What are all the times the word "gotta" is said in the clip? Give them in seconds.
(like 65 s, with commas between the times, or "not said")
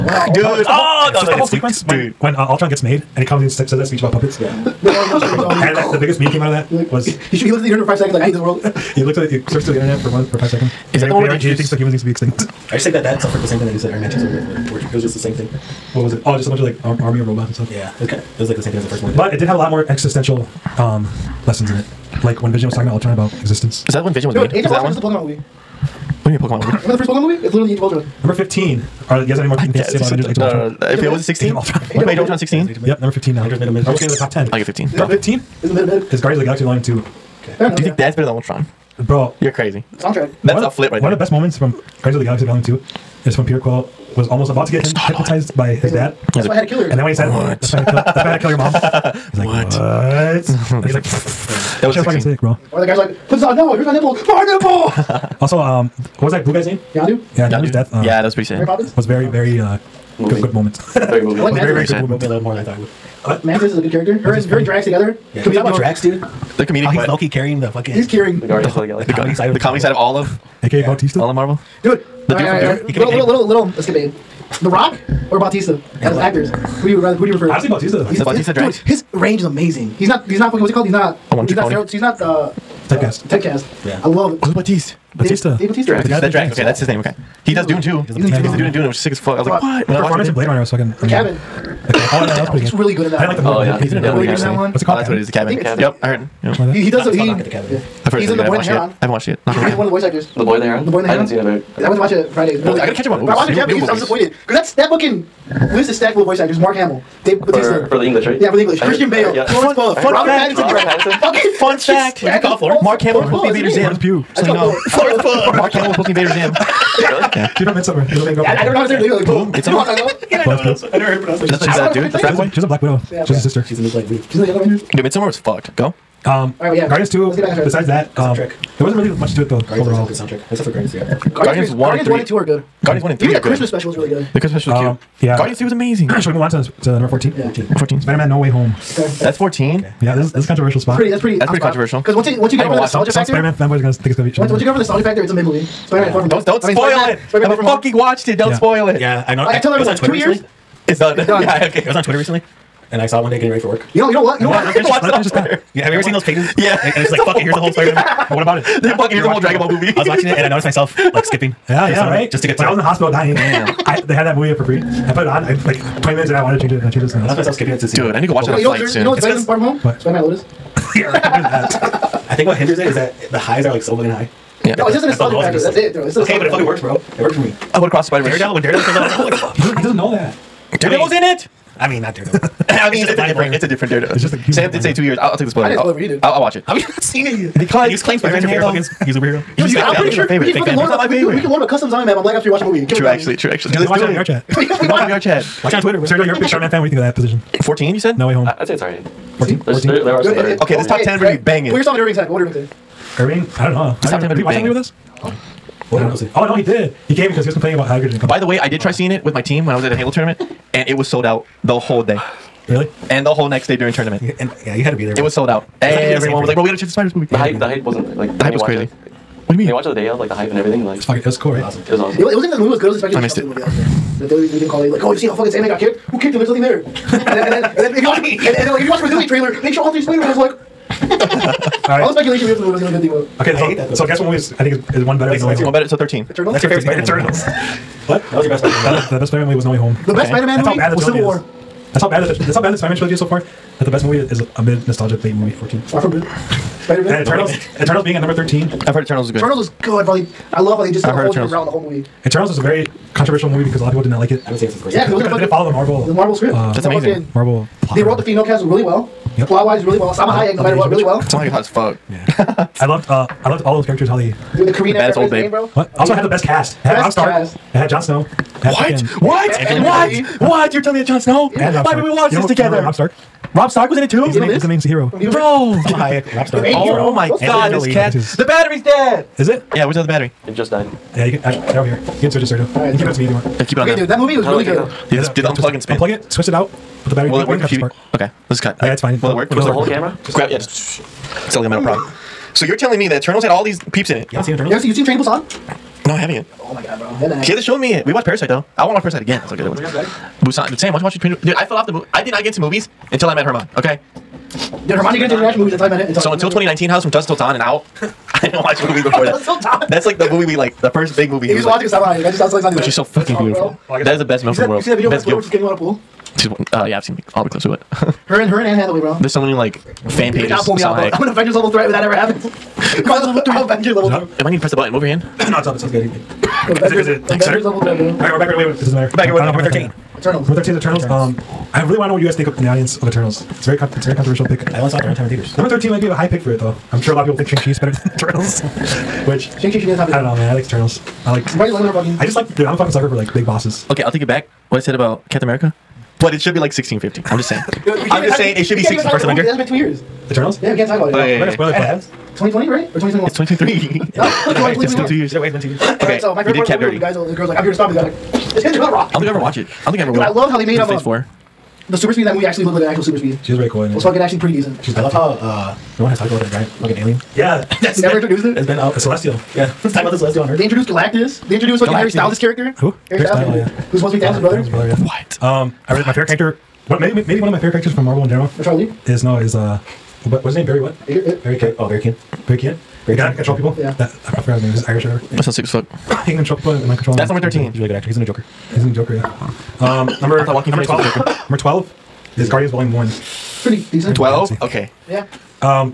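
102 s, 216 s.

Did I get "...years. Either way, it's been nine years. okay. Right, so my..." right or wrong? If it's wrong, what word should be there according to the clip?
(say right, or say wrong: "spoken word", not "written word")
wrong: "two", not "nine".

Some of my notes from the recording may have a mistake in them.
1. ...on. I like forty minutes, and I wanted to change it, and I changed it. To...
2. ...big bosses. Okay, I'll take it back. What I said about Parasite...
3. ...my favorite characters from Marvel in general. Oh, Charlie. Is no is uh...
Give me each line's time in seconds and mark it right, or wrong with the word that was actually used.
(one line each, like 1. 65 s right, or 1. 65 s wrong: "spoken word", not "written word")
1. 165 s wrong: "twenty", not "forty"
2. 343 s wrong: "Captain", not "Parasite"
3. 377 s right.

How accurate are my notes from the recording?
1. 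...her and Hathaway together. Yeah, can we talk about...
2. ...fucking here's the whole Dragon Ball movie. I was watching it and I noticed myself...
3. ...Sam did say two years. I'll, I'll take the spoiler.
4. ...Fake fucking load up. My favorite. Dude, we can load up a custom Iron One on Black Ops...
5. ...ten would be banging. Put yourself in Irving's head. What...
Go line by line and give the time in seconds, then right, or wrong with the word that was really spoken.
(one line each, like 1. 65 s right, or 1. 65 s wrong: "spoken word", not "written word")
1. 64 s wrong: "Drax", not "Hathaway"
2. 158 s right
3. 184 s right
4. 190 s wrong: "Man", not "One"
5. 201 s right.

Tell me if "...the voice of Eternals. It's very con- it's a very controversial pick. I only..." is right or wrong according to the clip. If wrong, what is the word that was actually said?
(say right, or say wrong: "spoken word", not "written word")
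wrong: "audience", not "voice".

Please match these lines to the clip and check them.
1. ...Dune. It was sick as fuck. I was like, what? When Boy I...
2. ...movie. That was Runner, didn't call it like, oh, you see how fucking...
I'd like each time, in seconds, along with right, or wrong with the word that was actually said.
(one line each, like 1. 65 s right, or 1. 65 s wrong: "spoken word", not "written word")
1. 88 s wrong: "His", not "Boy"
2. 223 s wrong: "They", not "Runner".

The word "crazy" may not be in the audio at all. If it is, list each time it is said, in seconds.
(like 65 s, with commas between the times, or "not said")
39 s, 218 s.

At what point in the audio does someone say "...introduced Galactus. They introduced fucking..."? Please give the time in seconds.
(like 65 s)
370 s.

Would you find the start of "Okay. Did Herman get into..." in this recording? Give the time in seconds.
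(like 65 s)
303 s.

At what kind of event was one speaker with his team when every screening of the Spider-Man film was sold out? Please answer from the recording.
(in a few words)
A Halo tournament.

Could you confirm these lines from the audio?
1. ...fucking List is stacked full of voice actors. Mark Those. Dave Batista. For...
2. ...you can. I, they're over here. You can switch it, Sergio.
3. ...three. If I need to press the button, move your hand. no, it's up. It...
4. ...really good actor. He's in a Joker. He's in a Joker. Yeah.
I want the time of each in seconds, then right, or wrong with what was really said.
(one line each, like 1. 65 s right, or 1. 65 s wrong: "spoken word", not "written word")
1. 104 s wrong: "Hamill", not "Those"
2. 281 s right
3. 324 s right
4. 387 s right.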